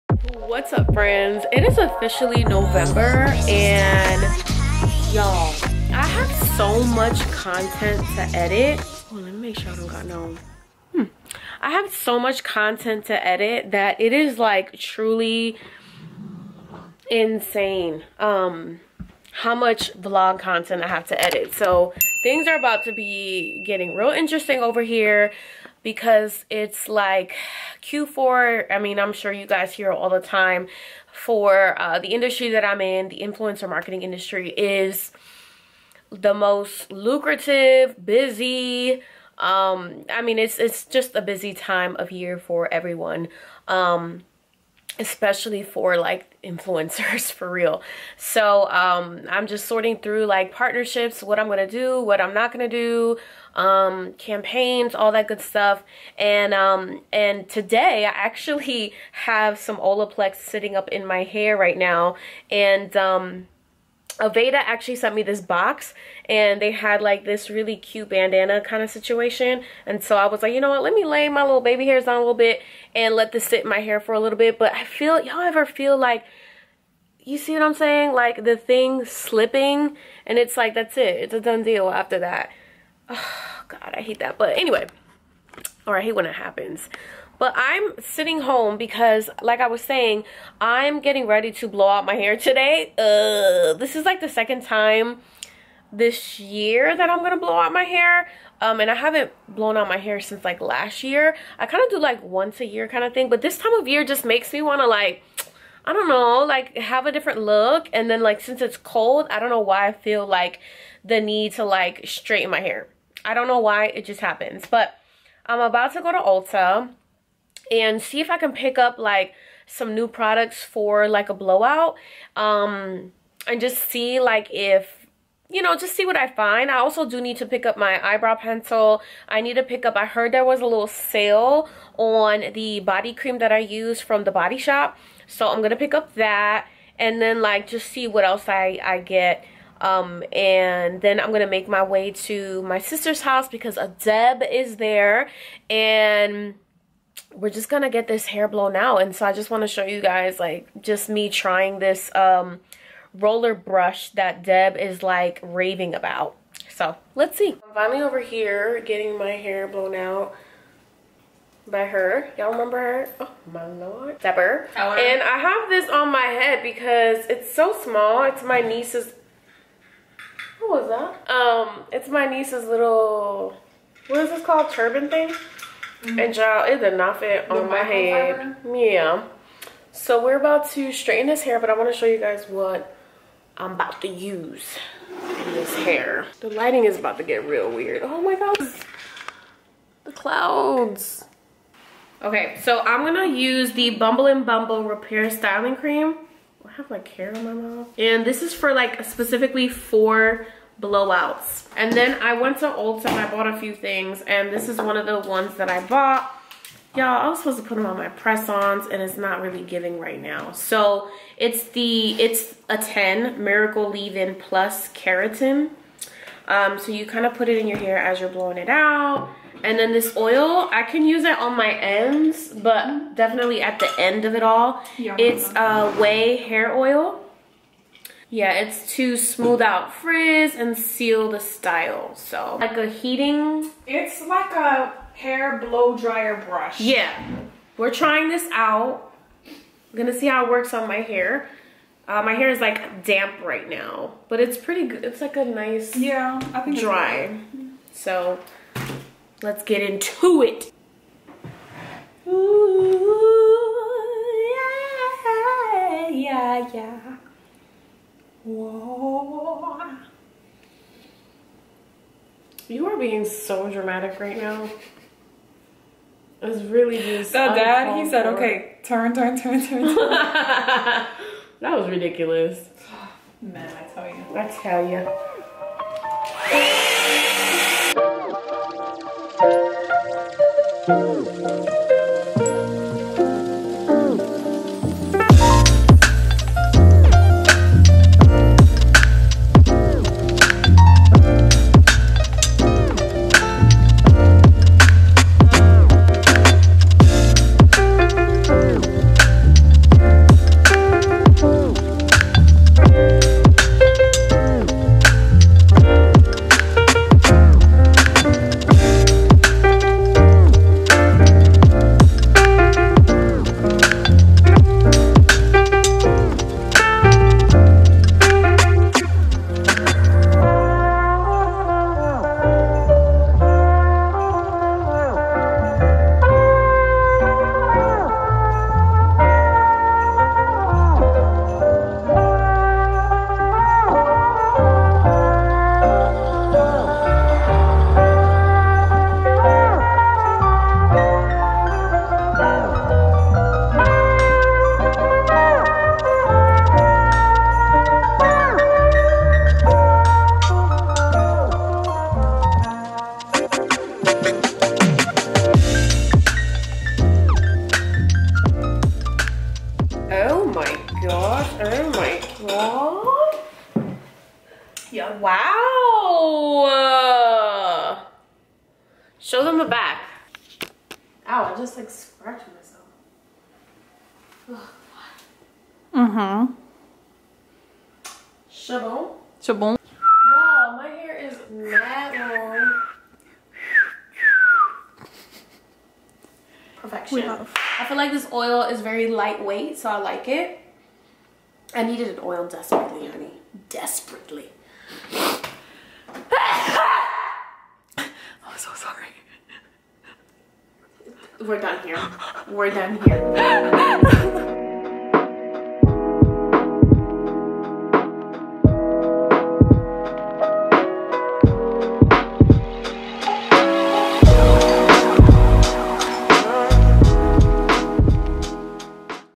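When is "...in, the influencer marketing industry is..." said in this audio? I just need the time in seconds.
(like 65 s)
32 s.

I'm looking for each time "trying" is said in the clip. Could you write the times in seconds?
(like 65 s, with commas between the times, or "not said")
151 s, 237 s.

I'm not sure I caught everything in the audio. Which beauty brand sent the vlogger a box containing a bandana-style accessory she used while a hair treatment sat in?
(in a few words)
Aveda.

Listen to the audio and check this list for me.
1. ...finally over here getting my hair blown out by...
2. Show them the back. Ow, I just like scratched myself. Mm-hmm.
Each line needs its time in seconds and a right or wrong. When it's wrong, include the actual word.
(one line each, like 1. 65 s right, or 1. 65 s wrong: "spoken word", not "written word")
1. 157 s right
2. 369 s right.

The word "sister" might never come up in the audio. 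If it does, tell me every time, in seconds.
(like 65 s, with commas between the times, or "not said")
142 s.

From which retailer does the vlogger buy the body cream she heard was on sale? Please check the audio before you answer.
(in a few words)
The Body Shop.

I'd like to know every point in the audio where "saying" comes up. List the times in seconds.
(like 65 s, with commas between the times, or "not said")
77 s, 89 s.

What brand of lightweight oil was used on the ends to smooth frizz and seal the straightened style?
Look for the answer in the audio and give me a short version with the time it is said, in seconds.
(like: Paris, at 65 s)
Ouai, at 225 s.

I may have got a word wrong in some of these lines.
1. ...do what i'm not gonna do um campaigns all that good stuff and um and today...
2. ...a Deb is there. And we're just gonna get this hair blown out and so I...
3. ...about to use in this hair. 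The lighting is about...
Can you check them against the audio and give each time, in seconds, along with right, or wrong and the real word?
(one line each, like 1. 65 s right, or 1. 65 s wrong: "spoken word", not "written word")
1. 51 s right
2. 143 s right
3. 183 s right.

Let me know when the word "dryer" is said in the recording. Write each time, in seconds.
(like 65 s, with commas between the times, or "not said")
235 s.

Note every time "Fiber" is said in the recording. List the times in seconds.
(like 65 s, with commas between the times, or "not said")
178 s.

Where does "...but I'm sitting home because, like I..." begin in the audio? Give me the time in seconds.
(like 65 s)
87 s.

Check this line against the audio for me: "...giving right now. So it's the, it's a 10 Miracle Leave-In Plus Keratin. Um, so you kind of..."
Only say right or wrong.
right.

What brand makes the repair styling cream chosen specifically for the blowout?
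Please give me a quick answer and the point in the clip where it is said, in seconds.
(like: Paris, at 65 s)
Bumble and Bumble, at 193 s.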